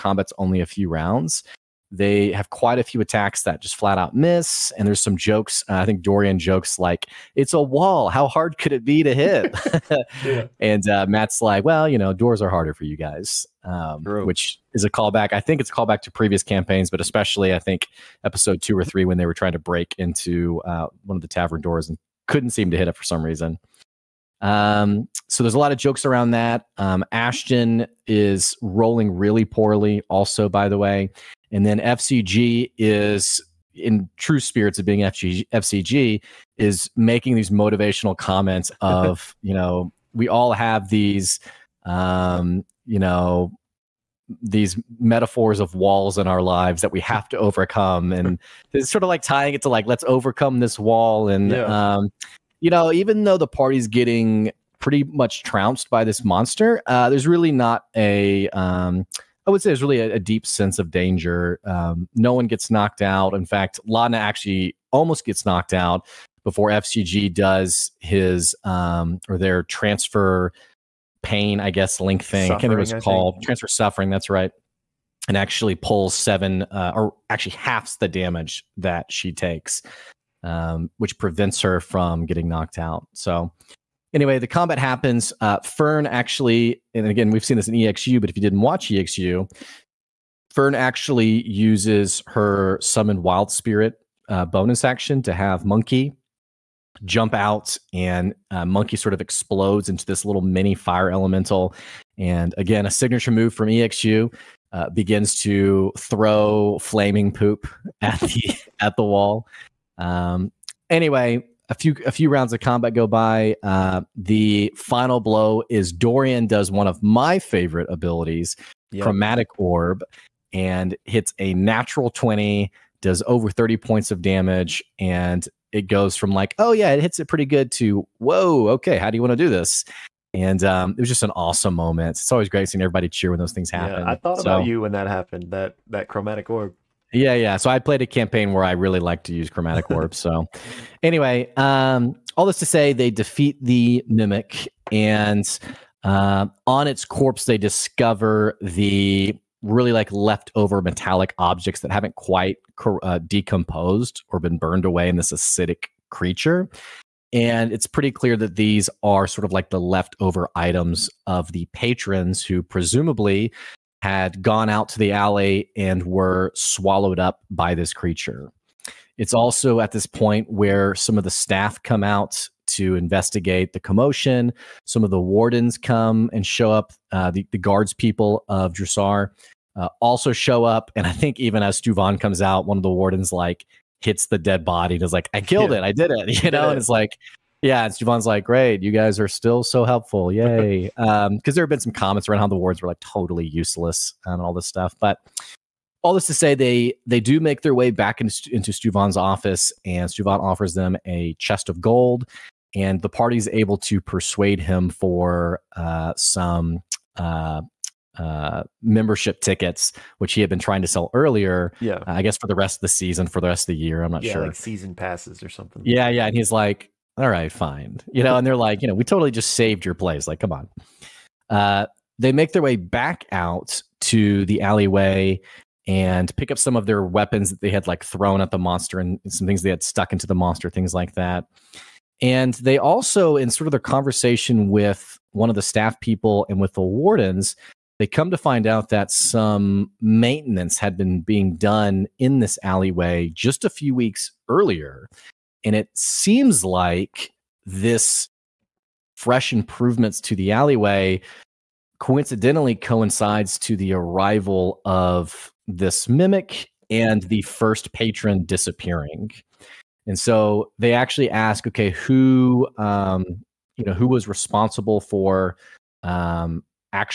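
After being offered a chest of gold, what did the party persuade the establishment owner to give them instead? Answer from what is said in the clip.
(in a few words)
Membership tickets.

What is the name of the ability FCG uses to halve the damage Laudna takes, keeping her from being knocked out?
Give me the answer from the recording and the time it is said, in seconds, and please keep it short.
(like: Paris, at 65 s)
Transfer suffering, at 73 s.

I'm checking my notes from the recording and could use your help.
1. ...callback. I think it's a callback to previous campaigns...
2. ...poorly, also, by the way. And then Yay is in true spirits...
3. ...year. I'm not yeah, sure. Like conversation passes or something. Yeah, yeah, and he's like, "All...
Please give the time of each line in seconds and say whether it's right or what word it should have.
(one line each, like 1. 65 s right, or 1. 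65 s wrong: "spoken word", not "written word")
1. 14 s right
2. 29 s wrong: "FCG", not "Yay"
3. 213 s wrong: "season", not "conversation".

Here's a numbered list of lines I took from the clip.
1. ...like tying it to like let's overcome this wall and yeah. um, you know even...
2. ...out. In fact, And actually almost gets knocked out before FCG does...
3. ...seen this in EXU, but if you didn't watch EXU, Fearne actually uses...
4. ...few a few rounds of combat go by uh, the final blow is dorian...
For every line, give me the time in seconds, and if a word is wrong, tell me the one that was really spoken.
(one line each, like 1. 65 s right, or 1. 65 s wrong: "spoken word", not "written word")
1. 49 s right
2. 62 s wrong: "Laudna", not "And"
3. 87 s right
4. 111 s right.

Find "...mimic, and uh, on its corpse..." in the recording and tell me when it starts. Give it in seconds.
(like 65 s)
144 s.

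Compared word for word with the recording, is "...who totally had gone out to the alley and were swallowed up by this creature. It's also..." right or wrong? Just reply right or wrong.
wrong.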